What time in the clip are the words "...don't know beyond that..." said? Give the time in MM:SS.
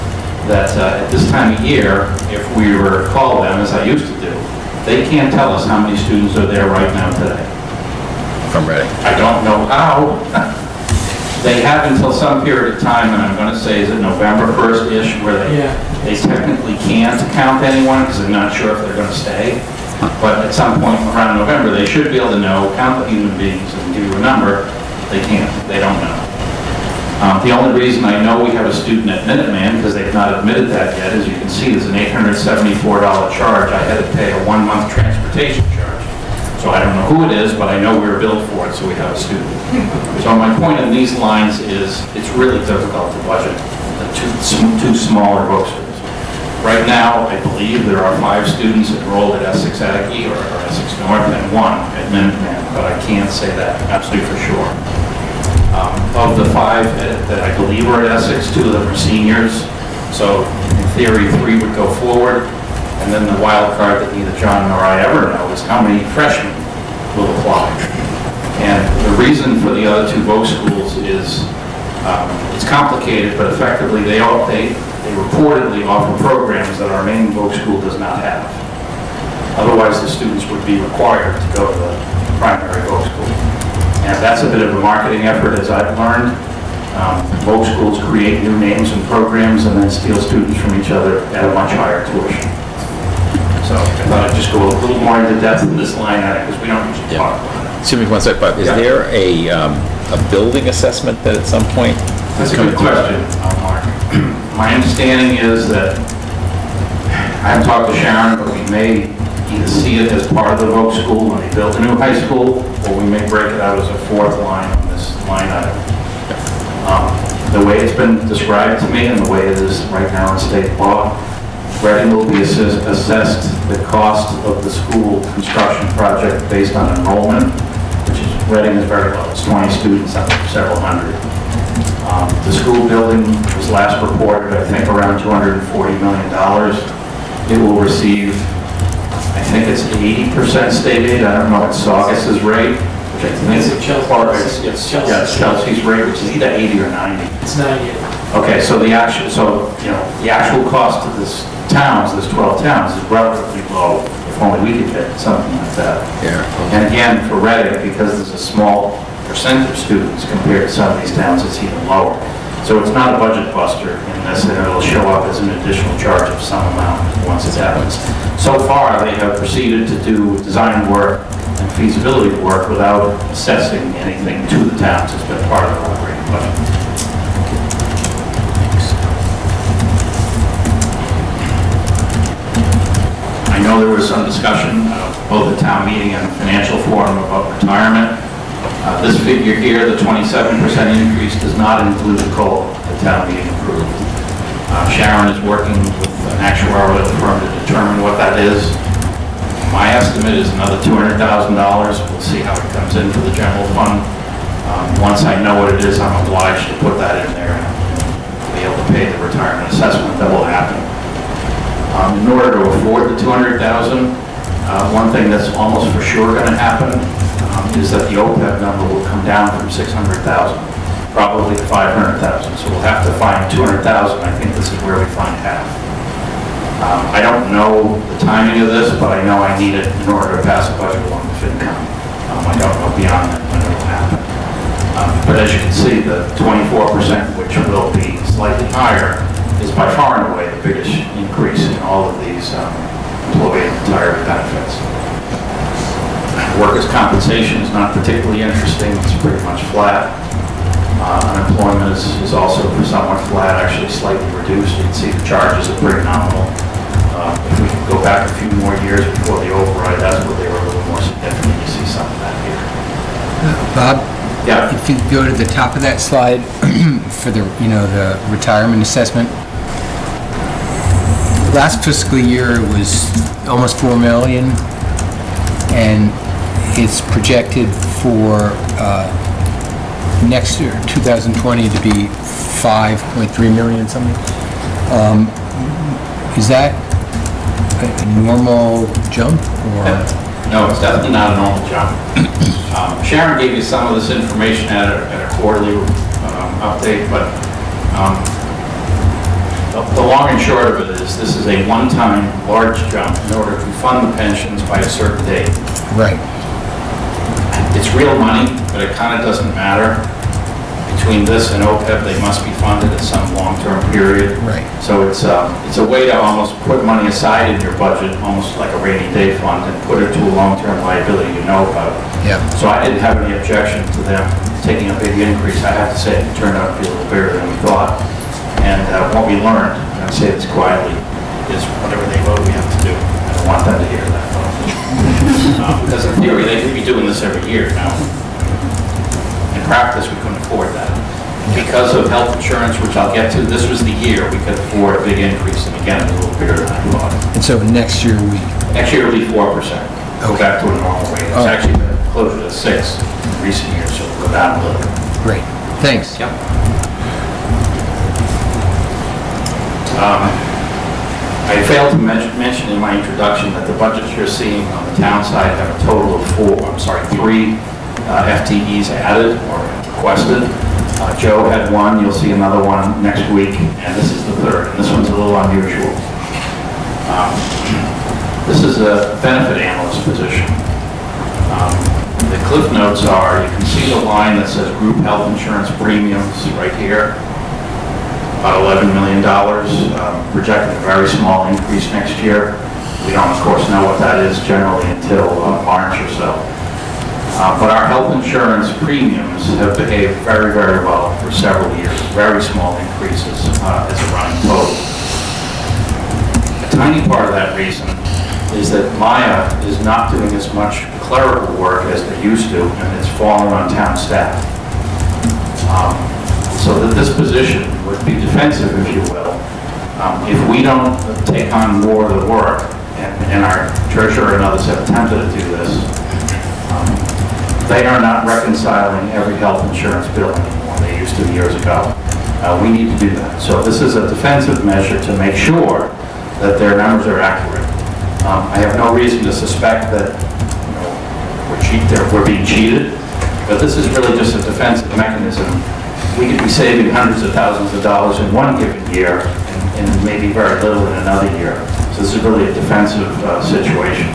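03:52.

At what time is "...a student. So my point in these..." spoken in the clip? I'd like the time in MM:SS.
00:39.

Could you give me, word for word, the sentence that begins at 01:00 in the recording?
So in theory, three would go forward.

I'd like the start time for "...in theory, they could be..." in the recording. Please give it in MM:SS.
05:36.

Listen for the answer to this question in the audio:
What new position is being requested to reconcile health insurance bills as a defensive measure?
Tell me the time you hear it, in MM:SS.
06:19.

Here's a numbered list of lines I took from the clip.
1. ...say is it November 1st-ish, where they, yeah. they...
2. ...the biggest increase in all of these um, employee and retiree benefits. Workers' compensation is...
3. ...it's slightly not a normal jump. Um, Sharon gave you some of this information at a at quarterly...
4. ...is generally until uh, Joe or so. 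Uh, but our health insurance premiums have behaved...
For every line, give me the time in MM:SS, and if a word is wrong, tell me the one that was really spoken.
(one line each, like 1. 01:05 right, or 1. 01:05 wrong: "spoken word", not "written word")
1. 00:13 right
2. 04:00 right
3. 04:50 wrong: "definitely", not "slightly"
4. 06:34 wrong: "March", not "Joe".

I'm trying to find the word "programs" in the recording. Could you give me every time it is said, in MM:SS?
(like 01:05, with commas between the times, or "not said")
01:16, 01:29.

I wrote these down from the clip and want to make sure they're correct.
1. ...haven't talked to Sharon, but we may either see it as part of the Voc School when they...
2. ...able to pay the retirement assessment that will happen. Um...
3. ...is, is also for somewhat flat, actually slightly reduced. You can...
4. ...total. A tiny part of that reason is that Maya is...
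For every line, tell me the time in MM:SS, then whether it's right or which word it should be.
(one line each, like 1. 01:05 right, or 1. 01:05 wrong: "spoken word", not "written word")
1. 01:47 right
2. 03:28 right
3. 04:11 right
4. 06:44 right.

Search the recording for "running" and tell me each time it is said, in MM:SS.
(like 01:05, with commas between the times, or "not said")
06:44.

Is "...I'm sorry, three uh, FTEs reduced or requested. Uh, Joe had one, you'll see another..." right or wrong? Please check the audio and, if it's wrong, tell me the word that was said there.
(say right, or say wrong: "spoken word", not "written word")
wrong: "added", not "reduced".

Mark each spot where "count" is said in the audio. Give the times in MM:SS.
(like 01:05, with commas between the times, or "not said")
00:17, 00:22.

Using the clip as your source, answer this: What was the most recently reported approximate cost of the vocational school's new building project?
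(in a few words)
$240 million.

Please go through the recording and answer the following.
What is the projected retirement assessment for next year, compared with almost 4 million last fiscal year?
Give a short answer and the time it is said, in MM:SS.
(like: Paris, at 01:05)
5.3 million, at 04:42.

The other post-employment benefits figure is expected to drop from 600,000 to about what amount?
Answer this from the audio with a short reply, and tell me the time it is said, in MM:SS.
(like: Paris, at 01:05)
500,000, at 03:41.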